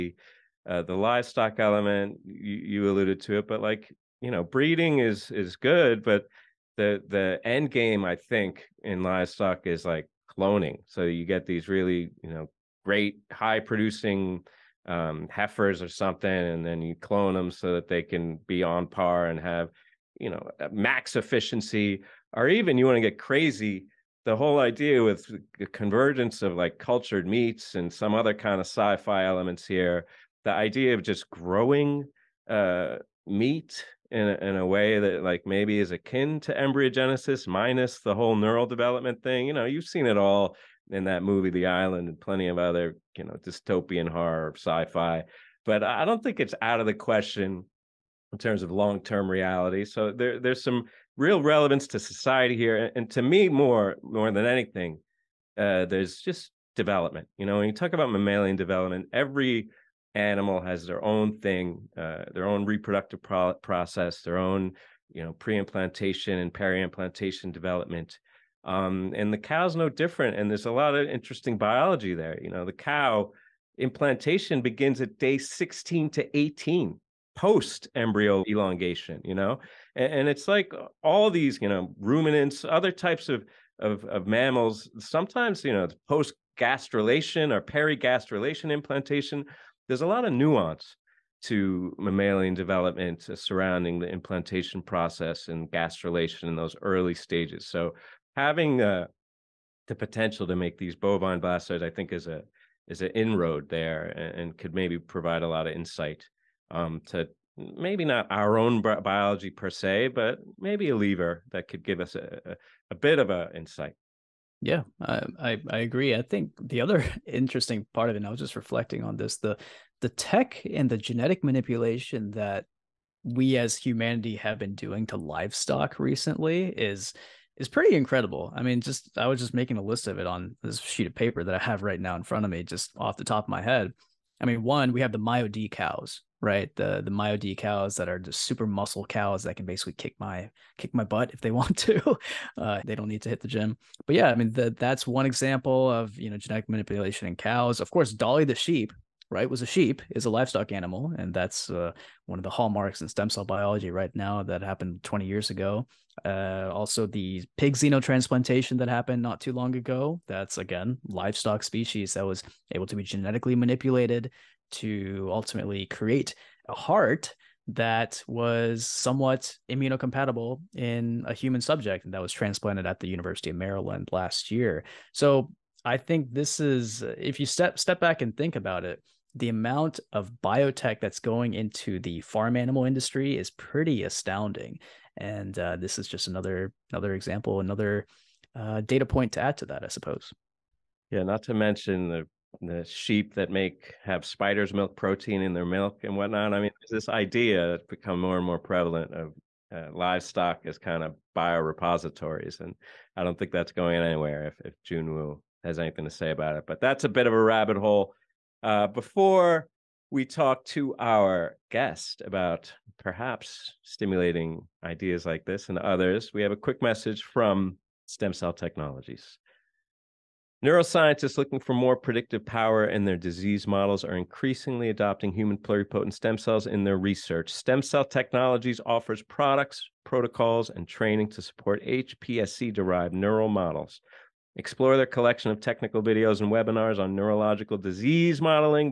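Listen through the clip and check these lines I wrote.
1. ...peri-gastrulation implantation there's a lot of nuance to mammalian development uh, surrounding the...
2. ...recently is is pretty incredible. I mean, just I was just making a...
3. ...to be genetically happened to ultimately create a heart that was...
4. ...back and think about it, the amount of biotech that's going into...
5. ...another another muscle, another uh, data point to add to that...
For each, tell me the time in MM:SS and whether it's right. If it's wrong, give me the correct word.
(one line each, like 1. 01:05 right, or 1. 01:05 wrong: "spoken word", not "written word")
1. 01:27 right
2. 02:05 right
3. 02:42 wrong: "manipulated", not "happened"
4. 02:57 right
5. 03:06 wrong: "example", not "muscle".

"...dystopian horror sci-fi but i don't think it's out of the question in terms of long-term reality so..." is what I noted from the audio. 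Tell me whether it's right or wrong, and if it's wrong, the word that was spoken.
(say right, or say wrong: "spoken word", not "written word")
right.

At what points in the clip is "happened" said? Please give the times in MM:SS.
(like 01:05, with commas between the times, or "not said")
02:34, 02:38.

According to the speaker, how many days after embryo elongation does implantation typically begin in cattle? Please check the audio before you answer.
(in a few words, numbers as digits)
16 to 18.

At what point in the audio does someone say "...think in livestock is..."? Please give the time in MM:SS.
00:08.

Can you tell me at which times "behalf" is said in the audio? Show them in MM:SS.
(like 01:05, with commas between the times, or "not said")
not said.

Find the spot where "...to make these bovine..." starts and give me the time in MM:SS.
01:40.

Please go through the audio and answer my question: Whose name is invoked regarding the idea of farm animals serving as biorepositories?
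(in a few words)
Jun Wu.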